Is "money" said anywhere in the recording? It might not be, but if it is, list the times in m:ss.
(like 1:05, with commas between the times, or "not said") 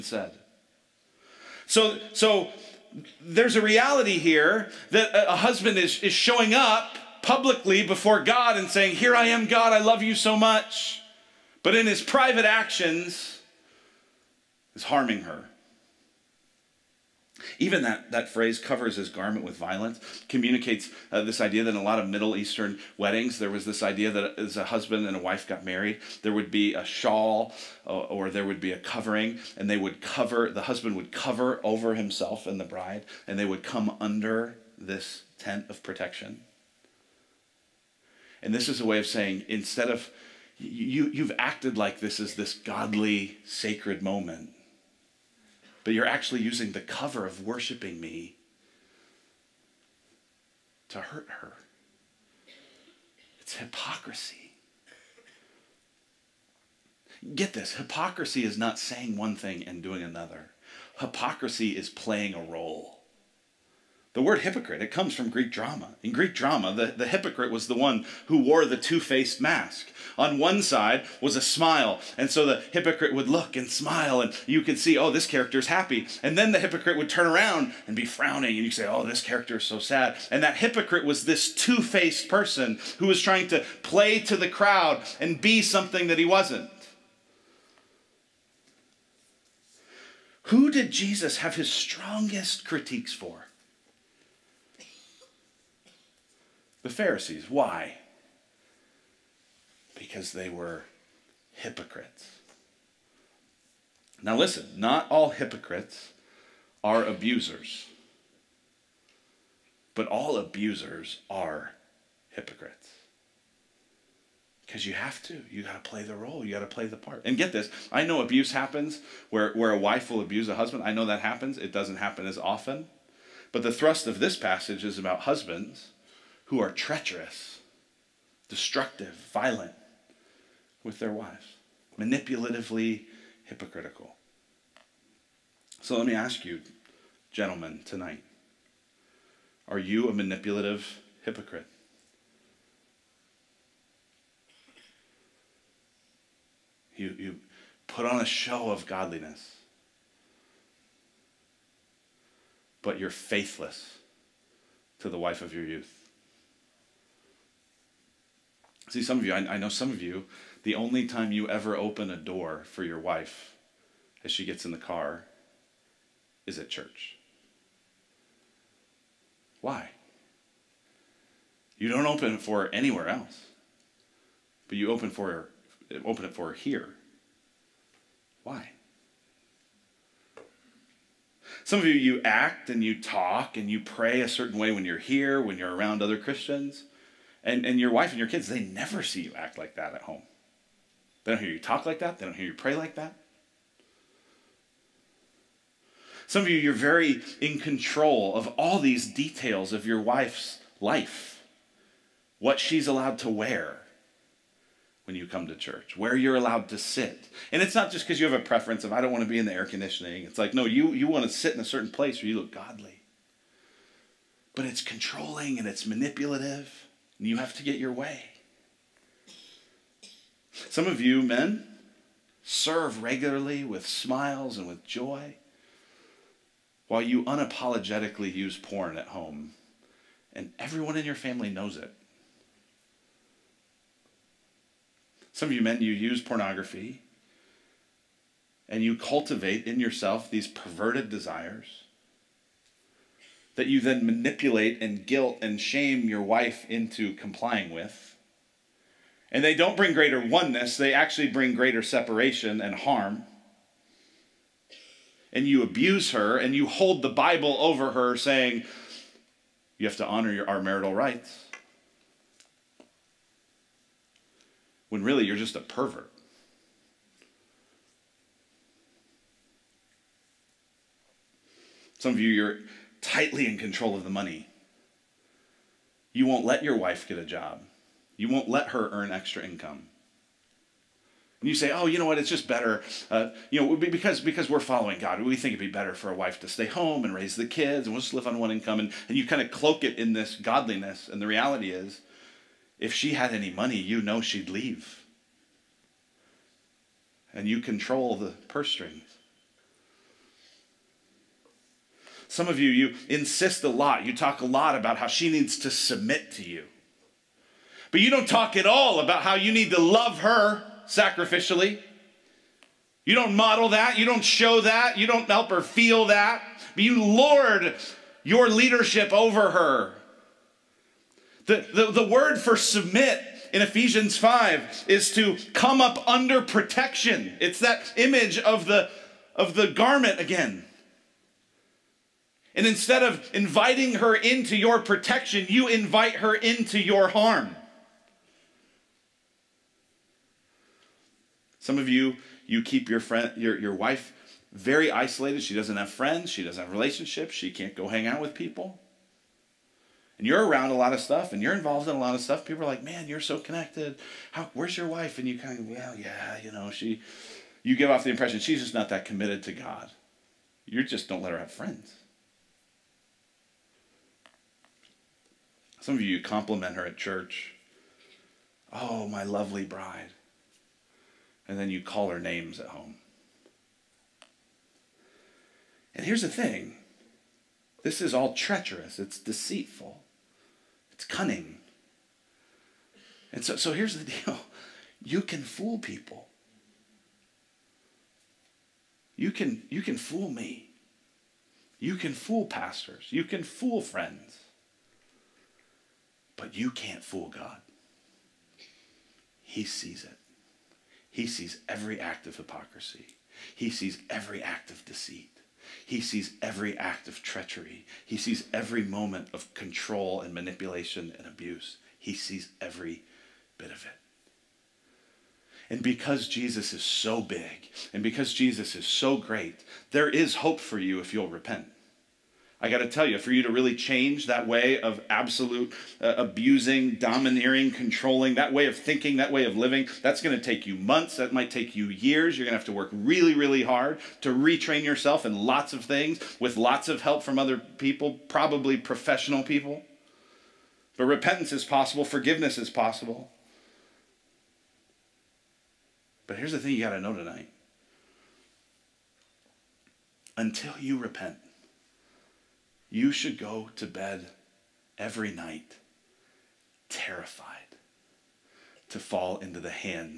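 4:34, 4:53.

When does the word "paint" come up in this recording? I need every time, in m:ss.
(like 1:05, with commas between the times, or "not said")
not said.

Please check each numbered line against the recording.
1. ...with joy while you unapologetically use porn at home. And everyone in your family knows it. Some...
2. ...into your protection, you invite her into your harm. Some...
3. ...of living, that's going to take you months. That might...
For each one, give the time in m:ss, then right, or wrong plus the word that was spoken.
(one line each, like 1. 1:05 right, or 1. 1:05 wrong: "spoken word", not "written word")
1. 3:44 right
2. 5:34 right
3. 7:09 right.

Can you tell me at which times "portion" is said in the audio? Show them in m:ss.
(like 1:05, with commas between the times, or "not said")
not said.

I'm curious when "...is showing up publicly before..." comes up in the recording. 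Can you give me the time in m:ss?
0:06.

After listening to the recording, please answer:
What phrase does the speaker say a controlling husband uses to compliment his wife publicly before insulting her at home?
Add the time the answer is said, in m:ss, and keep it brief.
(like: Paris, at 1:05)
my lovely bride, at 6:09.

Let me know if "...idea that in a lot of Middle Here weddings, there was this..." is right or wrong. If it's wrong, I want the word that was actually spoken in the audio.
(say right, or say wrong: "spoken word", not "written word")
wrong: "Eastern", not "Here".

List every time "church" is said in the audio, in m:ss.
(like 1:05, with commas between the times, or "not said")
2:46, 3:25, 6:06.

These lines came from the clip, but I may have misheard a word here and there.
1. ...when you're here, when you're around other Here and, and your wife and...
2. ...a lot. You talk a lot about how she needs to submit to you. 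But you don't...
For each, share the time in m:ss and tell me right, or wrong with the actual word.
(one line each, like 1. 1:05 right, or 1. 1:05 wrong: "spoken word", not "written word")
1. 3:04 wrong: "Christians", not "Here"
2. 5:03 right.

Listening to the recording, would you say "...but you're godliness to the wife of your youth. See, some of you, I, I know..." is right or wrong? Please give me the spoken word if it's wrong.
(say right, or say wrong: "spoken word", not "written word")
wrong: "faithless", not "godliness".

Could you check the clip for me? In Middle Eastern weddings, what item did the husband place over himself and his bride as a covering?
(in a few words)
a shawl.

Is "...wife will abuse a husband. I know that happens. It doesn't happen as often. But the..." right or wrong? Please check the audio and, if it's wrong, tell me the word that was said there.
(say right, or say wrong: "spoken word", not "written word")
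right.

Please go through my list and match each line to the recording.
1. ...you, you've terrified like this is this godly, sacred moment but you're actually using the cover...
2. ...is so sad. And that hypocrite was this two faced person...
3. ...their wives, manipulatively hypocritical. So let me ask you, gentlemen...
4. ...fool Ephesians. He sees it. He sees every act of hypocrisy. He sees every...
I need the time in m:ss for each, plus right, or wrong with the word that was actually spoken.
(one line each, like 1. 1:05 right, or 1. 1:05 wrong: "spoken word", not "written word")
1. 0:40 wrong: "acted", not "terrified"
2. 1:19 right
3. 2:10 right
4. 6:37 wrong: "God", not "Ephesians".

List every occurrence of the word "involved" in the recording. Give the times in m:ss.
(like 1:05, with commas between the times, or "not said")
5:51.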